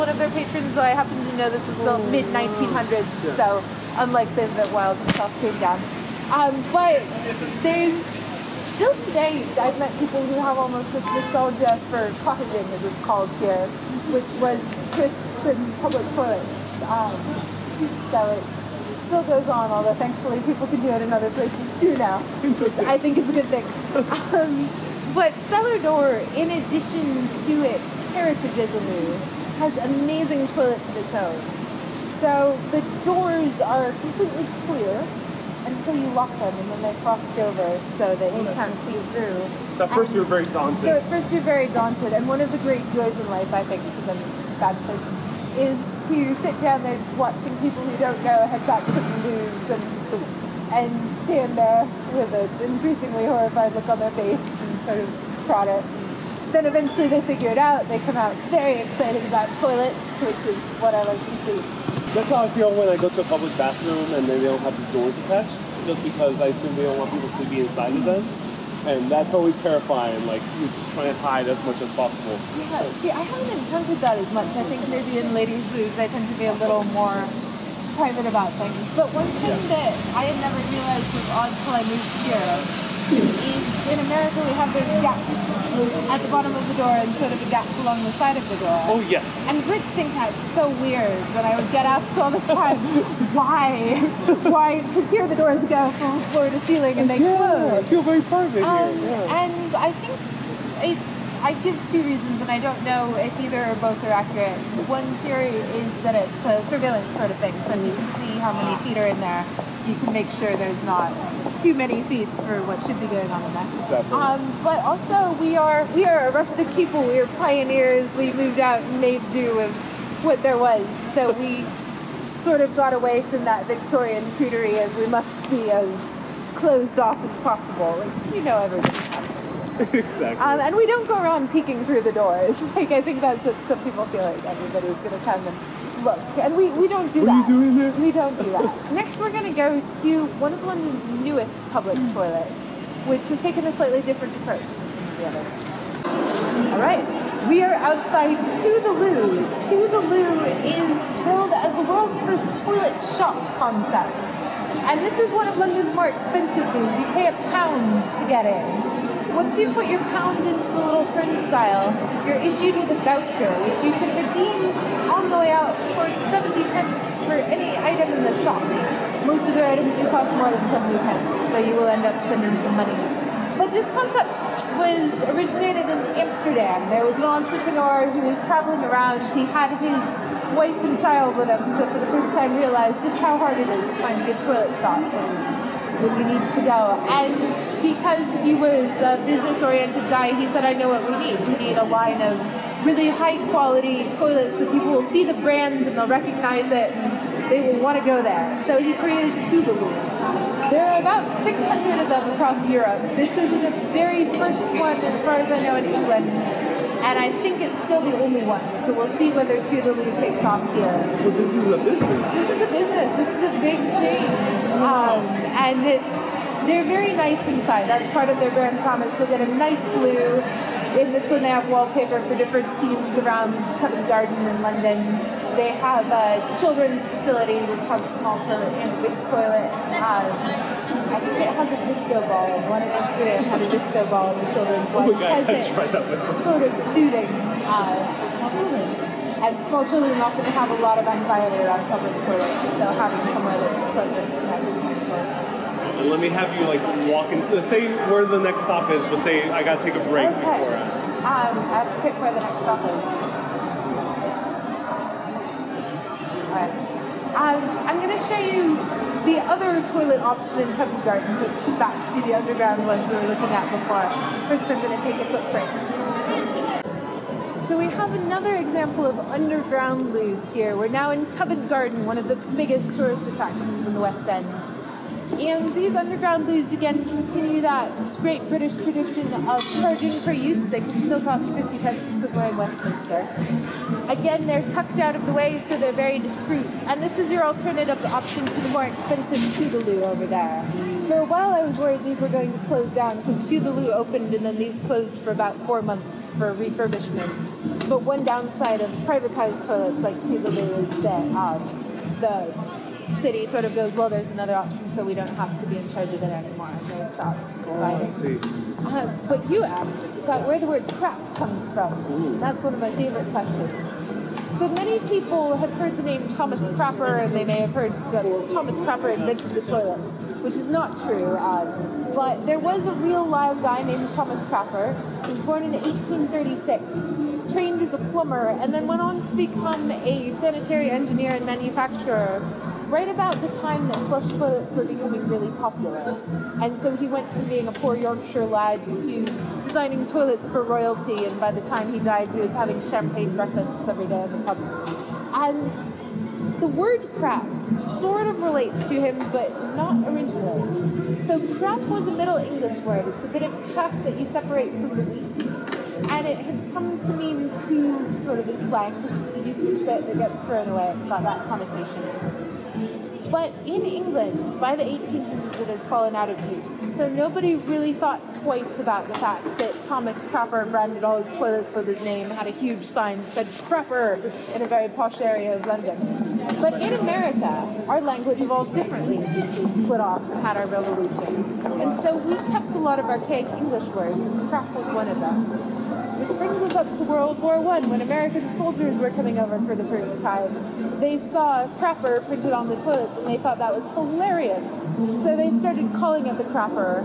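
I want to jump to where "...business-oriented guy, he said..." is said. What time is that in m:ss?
3:09.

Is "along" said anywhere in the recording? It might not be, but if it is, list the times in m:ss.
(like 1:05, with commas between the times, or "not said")
1:27.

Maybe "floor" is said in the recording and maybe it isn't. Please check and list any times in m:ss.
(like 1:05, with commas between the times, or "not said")
1:36.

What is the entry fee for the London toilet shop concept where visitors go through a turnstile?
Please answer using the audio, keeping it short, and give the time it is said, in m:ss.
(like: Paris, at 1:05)
1 pound, at 2:37.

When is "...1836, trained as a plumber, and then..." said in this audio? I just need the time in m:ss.
5:25.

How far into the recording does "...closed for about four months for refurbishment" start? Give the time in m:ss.
4:54.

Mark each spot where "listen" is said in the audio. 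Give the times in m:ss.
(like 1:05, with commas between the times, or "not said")
not said.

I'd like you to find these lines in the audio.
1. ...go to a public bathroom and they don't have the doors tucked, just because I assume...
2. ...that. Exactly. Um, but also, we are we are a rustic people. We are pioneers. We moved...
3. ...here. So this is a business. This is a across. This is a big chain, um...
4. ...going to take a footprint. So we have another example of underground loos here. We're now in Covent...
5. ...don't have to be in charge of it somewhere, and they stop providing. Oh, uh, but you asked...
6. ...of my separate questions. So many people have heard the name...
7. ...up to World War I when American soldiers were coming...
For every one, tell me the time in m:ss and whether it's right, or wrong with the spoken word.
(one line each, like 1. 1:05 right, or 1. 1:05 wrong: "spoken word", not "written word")
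1. 1:02 wrong: "attached", not "tucked"
2. 1:53 right
3. 3:30 wrong: "business", not "across"
4. 4:24 right
5. 5:05 wrong: "anymore", not "somewhere"
6. 5:12 wrong: "favorite", not "separate"
7. 6:26 right.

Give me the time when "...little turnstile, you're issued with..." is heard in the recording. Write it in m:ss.
2:40.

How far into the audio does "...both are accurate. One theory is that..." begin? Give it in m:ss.
1:43.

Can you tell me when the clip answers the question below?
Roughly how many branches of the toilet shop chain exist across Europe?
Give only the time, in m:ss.
3:21.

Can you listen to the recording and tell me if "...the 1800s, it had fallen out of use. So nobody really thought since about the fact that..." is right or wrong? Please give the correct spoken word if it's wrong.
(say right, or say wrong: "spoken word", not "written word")
wrong: "twice", not "since".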